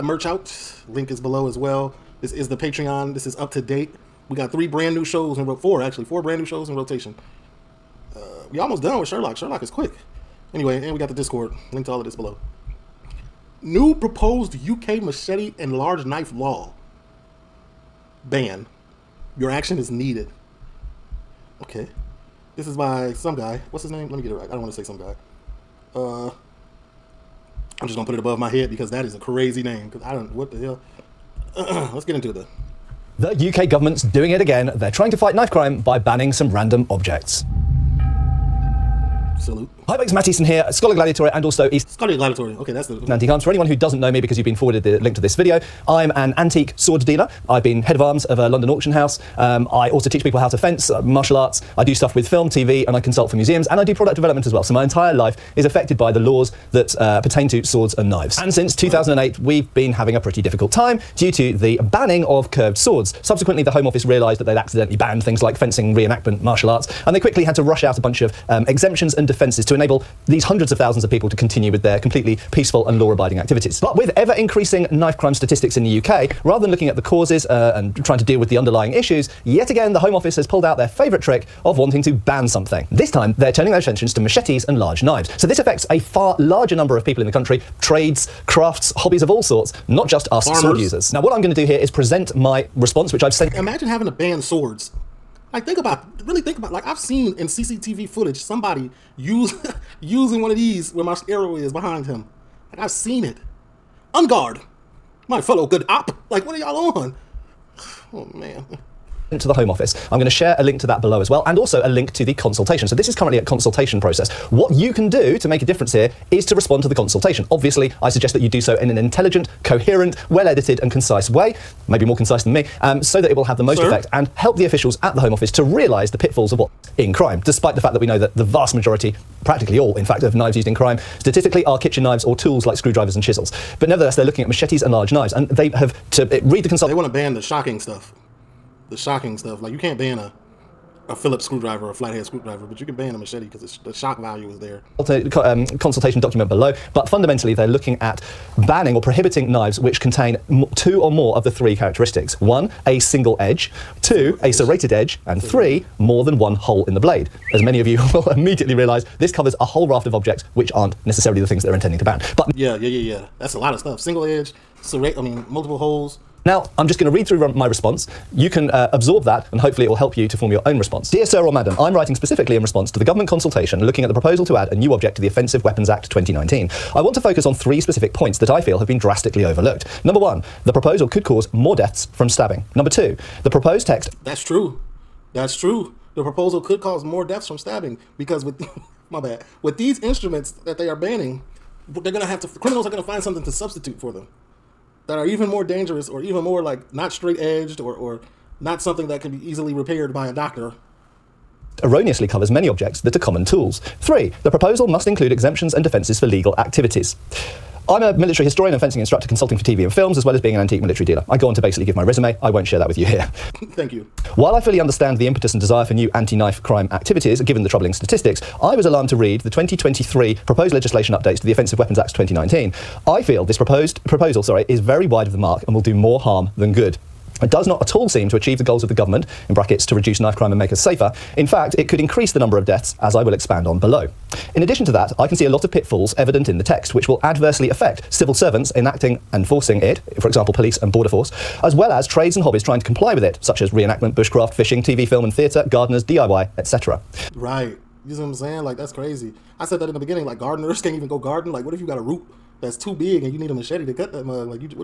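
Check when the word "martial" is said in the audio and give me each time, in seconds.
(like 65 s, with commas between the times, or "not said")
51 s, 66 s.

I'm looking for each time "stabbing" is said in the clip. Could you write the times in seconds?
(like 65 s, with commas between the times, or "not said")
182 s, 187 s.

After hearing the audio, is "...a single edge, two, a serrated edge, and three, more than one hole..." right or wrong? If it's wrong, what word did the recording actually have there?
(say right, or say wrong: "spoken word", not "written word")
right.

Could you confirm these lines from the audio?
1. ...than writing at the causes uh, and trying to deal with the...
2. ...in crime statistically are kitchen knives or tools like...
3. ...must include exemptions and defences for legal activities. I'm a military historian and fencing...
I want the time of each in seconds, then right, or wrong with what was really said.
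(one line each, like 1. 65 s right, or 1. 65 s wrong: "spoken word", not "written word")
1. 76 s wrong: "looking", not "writing"
2. 130 s right
3. 204 s right.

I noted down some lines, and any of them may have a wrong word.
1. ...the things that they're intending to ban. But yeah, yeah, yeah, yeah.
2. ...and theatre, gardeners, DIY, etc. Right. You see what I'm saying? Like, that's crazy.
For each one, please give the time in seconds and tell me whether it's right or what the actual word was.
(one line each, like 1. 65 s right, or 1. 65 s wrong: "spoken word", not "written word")
1. 161 s right
2. 245 s right.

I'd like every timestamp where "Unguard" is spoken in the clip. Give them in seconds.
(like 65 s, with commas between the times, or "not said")
104 s.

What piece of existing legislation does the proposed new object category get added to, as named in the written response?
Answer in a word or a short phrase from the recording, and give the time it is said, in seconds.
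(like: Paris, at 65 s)
Offensive Weapons Act 2019, at 175 s.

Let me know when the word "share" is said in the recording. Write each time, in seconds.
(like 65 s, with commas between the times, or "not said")
110 s, 212 s.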